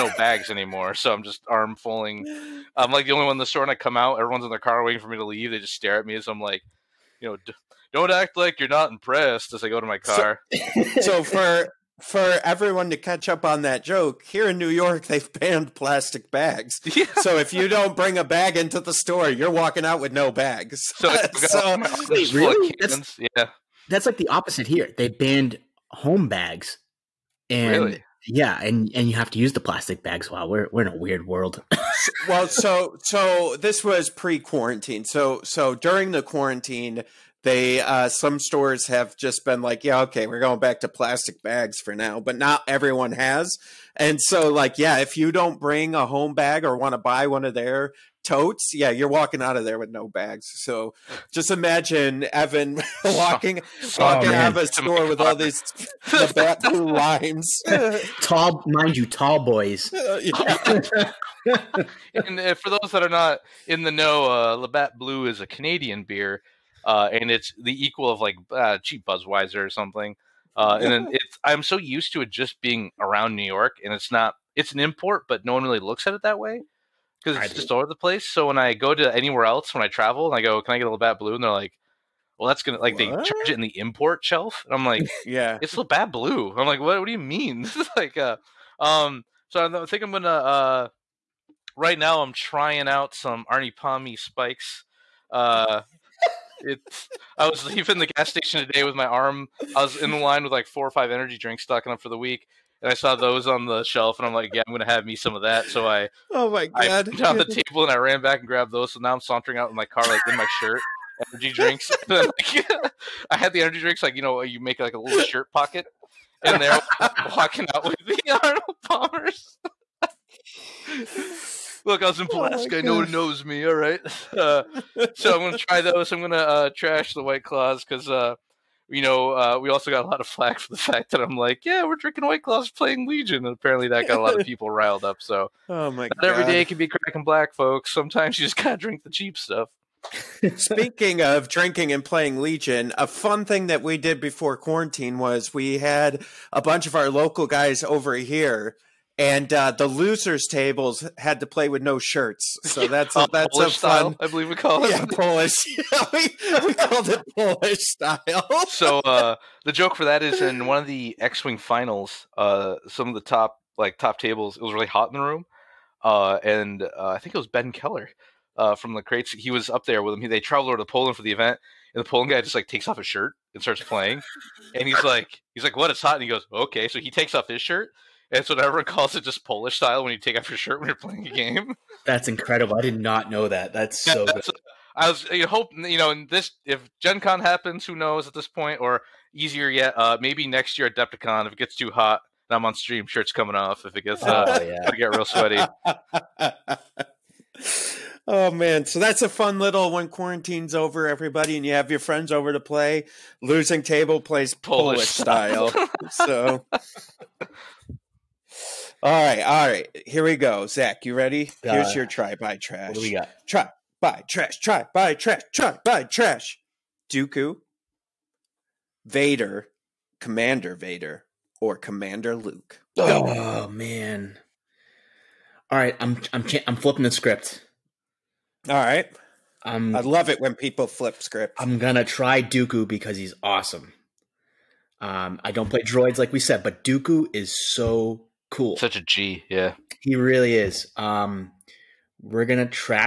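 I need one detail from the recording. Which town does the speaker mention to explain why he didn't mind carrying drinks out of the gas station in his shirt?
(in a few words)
Pulaski.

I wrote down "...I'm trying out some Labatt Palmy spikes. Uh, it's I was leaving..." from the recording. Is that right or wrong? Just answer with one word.
wrong.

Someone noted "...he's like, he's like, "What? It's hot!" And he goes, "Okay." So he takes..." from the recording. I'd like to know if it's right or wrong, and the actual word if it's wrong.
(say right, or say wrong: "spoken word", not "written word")
right.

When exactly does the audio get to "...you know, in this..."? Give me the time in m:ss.
3:05.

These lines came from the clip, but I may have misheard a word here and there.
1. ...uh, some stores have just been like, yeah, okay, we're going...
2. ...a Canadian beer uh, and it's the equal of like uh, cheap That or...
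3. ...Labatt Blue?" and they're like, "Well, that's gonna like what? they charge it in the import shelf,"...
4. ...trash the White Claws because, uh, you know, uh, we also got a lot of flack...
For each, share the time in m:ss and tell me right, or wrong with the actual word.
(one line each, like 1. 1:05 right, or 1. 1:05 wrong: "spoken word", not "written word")
1. 0:37 right
2. 1:05 wrong: "Budweiser", not "That"
3. 1:20 right
4. 2:06 right.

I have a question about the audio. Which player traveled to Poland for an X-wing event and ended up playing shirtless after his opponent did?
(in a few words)
Ben Keller.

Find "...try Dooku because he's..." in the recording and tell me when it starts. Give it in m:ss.
3:52.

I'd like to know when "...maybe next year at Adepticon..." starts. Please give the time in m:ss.
3:10.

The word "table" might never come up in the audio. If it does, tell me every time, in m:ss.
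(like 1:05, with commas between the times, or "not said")
1:47, 2:30, 2:44, 3:23.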